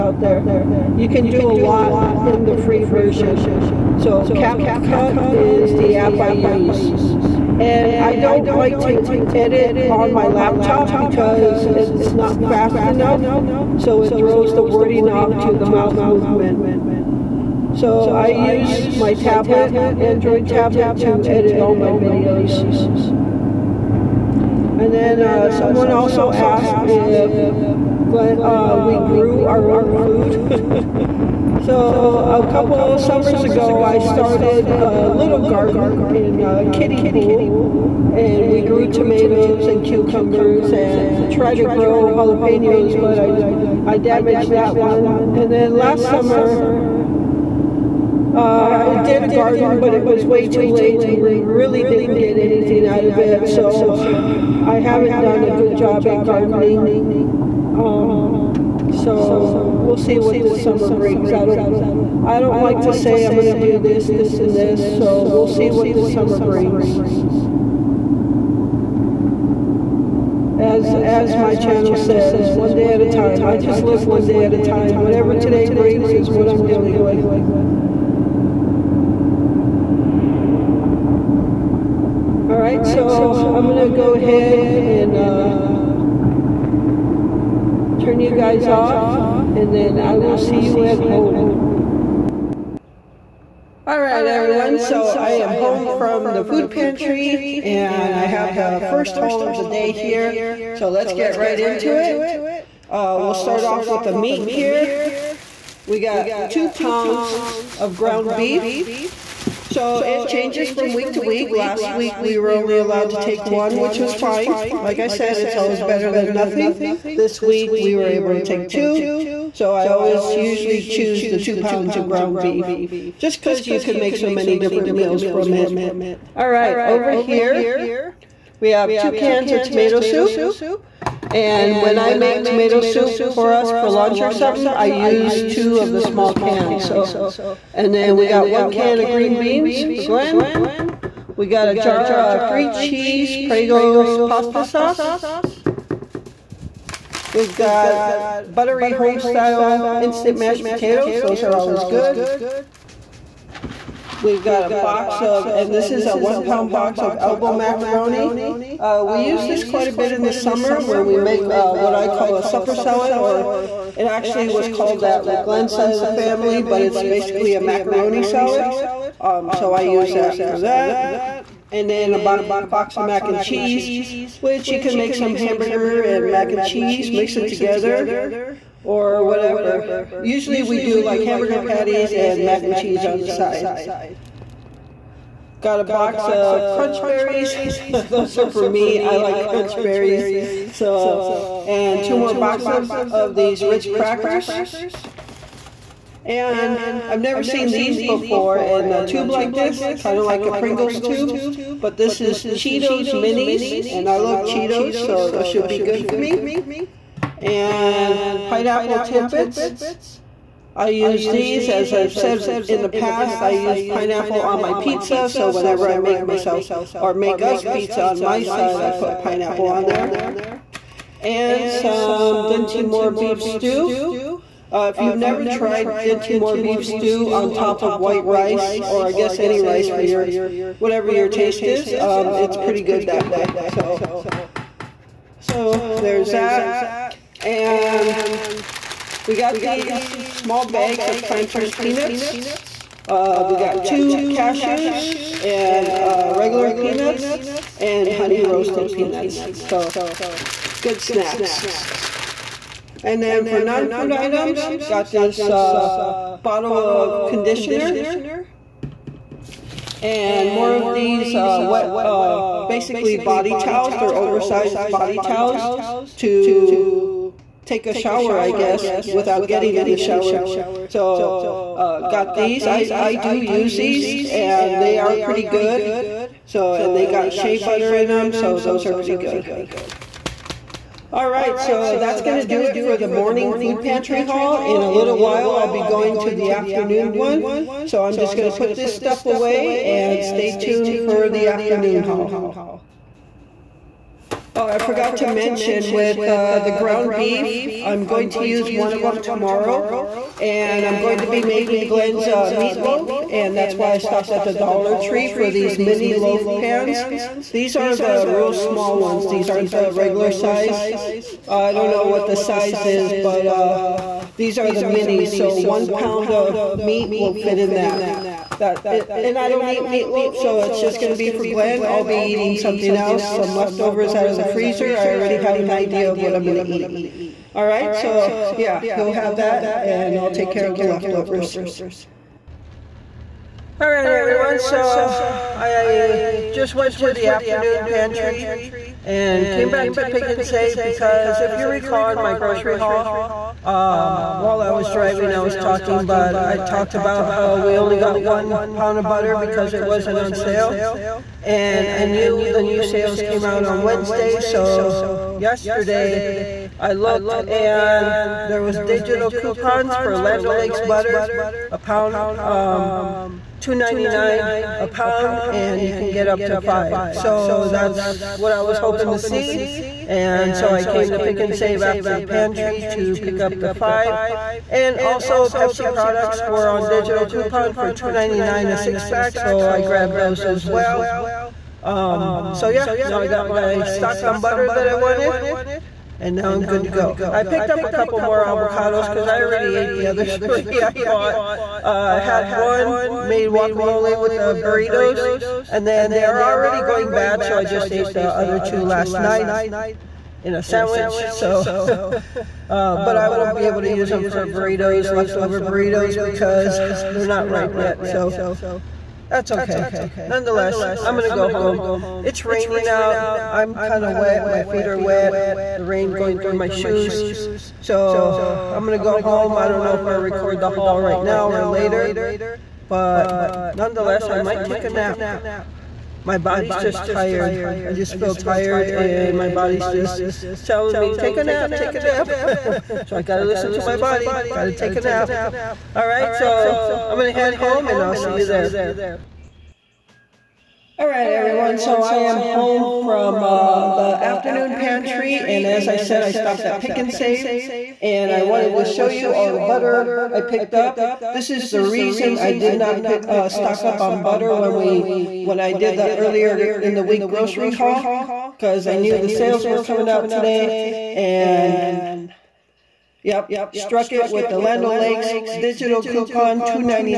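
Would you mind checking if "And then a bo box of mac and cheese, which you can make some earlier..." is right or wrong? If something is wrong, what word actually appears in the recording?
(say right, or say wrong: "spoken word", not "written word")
wrong: "hamburger", not "earlier".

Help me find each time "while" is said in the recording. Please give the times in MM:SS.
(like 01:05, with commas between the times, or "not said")
04:45, 05:44.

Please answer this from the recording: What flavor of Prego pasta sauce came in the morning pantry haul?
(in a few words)
three cheese.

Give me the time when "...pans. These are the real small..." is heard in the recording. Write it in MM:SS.
05:06.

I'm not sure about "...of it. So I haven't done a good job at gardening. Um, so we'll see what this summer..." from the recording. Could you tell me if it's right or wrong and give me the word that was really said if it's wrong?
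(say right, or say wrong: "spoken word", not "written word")
right.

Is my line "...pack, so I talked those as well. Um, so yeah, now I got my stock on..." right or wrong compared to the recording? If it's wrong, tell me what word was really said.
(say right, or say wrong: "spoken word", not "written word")
wrong: "grabbed", not "talked".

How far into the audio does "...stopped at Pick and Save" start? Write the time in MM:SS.
07:26.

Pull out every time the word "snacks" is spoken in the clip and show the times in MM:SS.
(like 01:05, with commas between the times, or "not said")
04:11.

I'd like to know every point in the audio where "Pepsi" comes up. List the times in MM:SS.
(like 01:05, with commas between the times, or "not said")
06:15.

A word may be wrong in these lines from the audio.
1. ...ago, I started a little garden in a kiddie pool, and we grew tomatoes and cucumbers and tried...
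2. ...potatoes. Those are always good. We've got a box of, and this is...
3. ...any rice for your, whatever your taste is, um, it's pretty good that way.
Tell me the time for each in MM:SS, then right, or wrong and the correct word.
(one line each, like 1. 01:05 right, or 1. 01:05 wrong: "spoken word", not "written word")
1. 00:33 right
2. 02:30 right
3. 03:49 right.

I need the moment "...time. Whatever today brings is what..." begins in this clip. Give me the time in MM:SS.
01:14.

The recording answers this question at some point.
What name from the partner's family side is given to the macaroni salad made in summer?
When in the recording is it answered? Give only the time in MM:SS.
02:42.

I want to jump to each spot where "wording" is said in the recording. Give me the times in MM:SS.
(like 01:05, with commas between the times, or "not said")
00:14.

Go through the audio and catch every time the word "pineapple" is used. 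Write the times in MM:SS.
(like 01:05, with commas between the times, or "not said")
03:28, 03:33, 03:39.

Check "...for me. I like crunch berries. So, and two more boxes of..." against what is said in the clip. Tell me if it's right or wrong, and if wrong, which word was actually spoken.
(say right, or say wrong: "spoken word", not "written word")
right.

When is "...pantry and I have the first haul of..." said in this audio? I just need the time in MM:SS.
01:36.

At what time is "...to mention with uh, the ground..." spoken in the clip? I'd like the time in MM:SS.
04:55.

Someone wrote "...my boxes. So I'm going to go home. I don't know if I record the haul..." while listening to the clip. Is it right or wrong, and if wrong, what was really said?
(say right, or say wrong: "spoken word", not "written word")
wrong: "shoes", not "boxes".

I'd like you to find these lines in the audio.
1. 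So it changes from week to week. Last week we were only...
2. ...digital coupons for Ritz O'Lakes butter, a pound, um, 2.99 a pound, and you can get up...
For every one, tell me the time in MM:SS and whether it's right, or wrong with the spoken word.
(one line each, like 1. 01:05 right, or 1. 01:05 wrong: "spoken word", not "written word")
1. 01:49 right
2. 05:58 wrong: "Land", not "Ritz".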